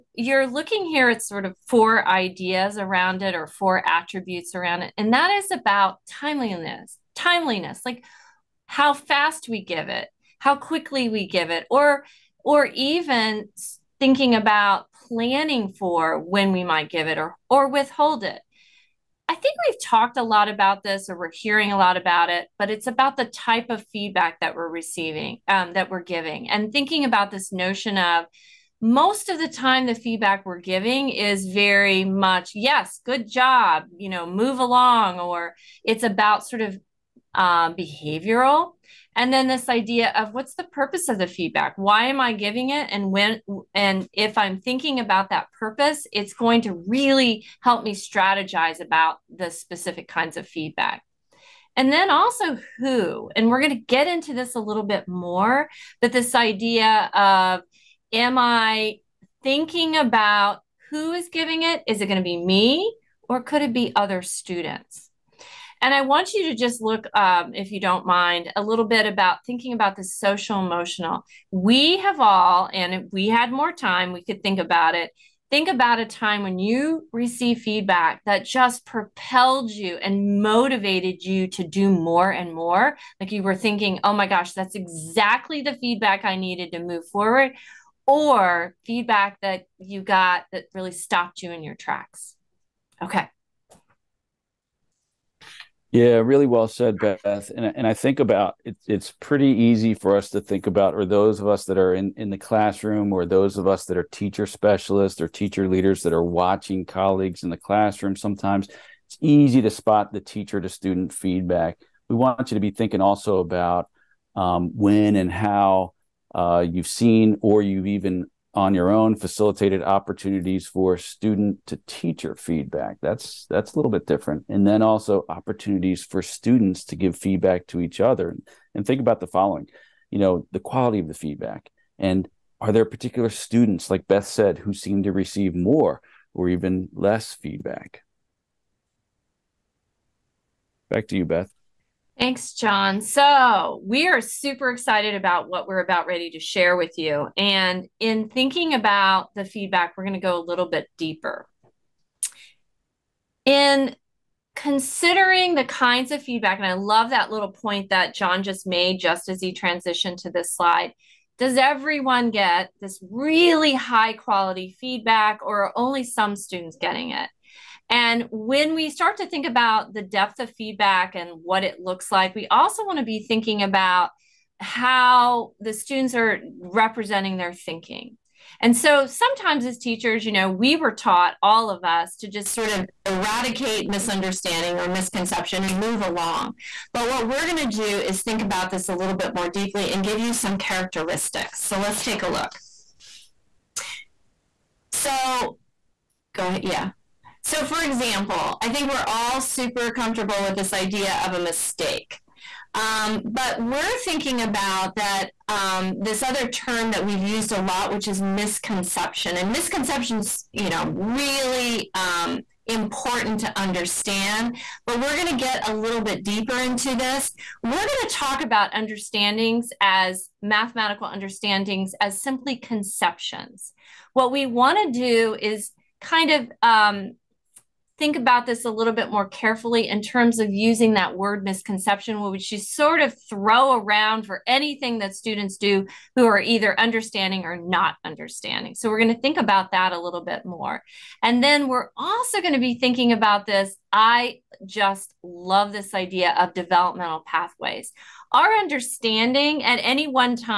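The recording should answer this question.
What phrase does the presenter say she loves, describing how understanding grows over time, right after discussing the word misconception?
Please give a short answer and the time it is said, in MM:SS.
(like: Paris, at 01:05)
developmental pathways, at 04:06.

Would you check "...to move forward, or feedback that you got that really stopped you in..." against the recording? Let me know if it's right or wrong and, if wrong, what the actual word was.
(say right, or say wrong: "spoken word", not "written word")
right.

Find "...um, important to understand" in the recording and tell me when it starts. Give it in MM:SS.
03:31.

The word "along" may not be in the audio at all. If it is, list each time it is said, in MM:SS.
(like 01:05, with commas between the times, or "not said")
00:34, 03:05.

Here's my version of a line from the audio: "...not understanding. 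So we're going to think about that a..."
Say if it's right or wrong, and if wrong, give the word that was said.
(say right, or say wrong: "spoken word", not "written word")
right.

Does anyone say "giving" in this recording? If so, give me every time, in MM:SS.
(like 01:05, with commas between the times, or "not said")
00:26, 00:30, 00:42, 01:01.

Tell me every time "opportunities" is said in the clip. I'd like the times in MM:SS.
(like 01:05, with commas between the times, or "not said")
01:59, 02:05.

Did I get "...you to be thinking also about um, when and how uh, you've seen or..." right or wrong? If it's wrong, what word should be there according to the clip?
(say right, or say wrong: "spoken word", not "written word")
right.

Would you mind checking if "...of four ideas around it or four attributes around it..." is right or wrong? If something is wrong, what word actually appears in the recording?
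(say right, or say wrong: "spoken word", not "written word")
right.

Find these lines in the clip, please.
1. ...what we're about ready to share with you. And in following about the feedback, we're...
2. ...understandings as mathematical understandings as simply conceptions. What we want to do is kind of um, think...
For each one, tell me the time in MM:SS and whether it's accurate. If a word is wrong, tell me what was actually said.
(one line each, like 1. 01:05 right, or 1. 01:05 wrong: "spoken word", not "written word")
1. 02:25 wrong: "thinking", not "following"
2. 03:38 right.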